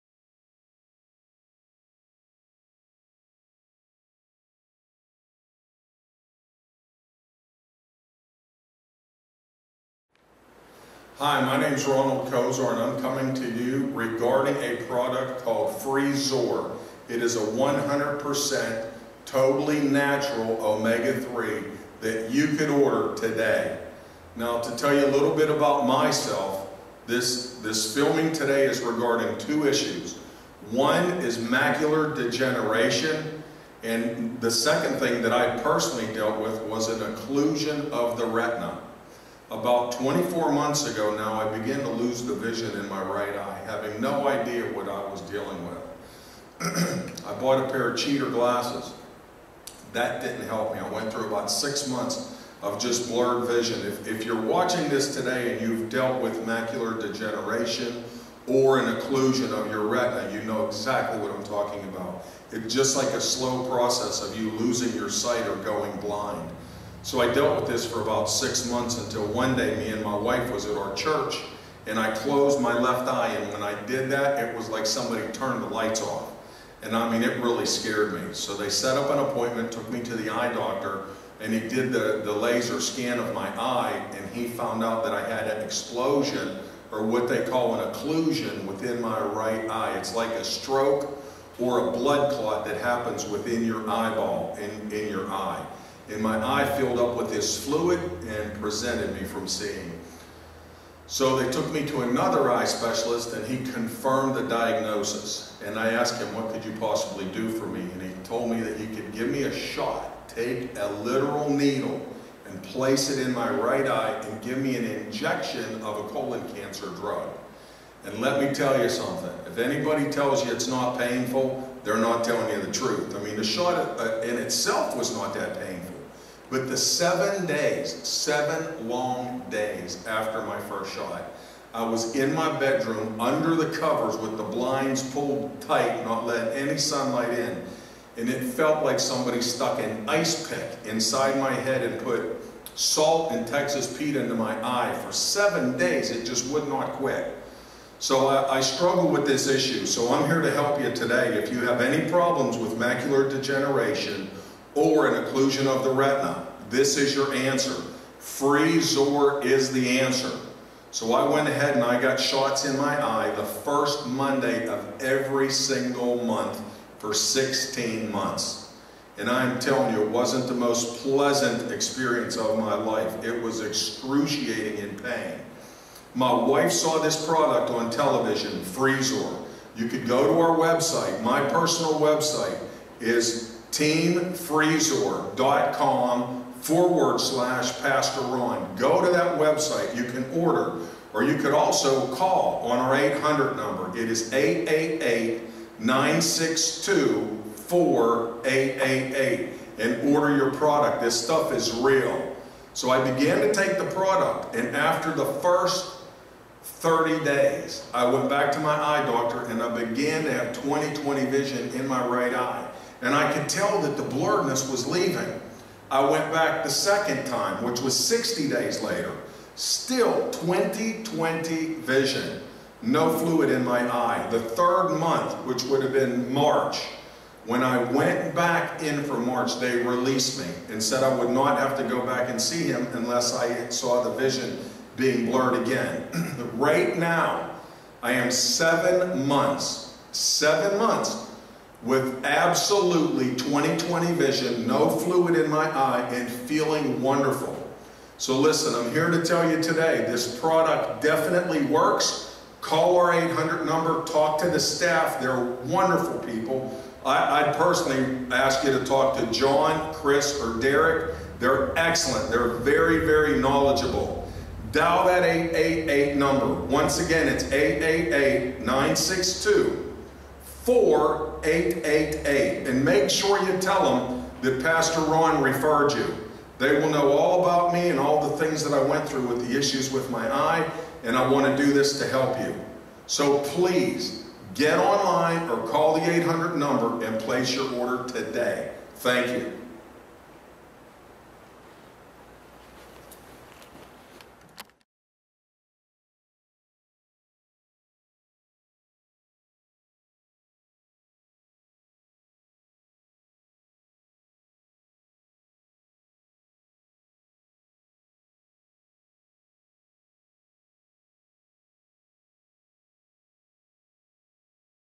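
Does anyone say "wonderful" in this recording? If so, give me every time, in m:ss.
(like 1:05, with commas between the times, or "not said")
4:07, 4:15.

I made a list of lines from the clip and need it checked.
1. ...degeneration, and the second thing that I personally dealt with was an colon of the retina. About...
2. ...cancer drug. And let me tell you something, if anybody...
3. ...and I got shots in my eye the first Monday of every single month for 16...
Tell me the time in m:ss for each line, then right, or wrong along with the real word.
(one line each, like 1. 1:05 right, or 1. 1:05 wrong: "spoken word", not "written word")
1. 0:32 wrong: "occlusion", not "colon"
2. 1:56 right
3. 2:41 right.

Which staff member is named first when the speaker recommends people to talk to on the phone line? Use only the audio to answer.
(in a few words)
John.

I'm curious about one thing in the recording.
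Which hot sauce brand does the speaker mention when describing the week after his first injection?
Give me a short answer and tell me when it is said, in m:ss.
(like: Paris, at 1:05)
Texas Pete, at 2:23.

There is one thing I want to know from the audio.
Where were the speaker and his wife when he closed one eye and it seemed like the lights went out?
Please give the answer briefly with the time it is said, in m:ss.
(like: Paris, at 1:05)
church, at 1:10.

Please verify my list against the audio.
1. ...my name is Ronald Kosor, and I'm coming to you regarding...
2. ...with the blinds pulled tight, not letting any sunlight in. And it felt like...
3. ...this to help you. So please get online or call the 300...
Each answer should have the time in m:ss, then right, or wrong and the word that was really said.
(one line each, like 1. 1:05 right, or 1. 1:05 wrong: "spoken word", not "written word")
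1. 0:11 right
2. 2:14 right
3. 4:41 wrong: "800", not "300".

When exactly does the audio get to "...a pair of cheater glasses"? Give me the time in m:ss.
0:47.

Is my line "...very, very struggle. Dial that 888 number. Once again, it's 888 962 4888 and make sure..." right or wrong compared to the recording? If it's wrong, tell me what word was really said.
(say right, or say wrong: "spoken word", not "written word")
wrong: "knowledgeable", not "struggle".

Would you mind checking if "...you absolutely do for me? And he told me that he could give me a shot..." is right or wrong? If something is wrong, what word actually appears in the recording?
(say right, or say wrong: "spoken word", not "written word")
wrong: "possibly", not "absolutely".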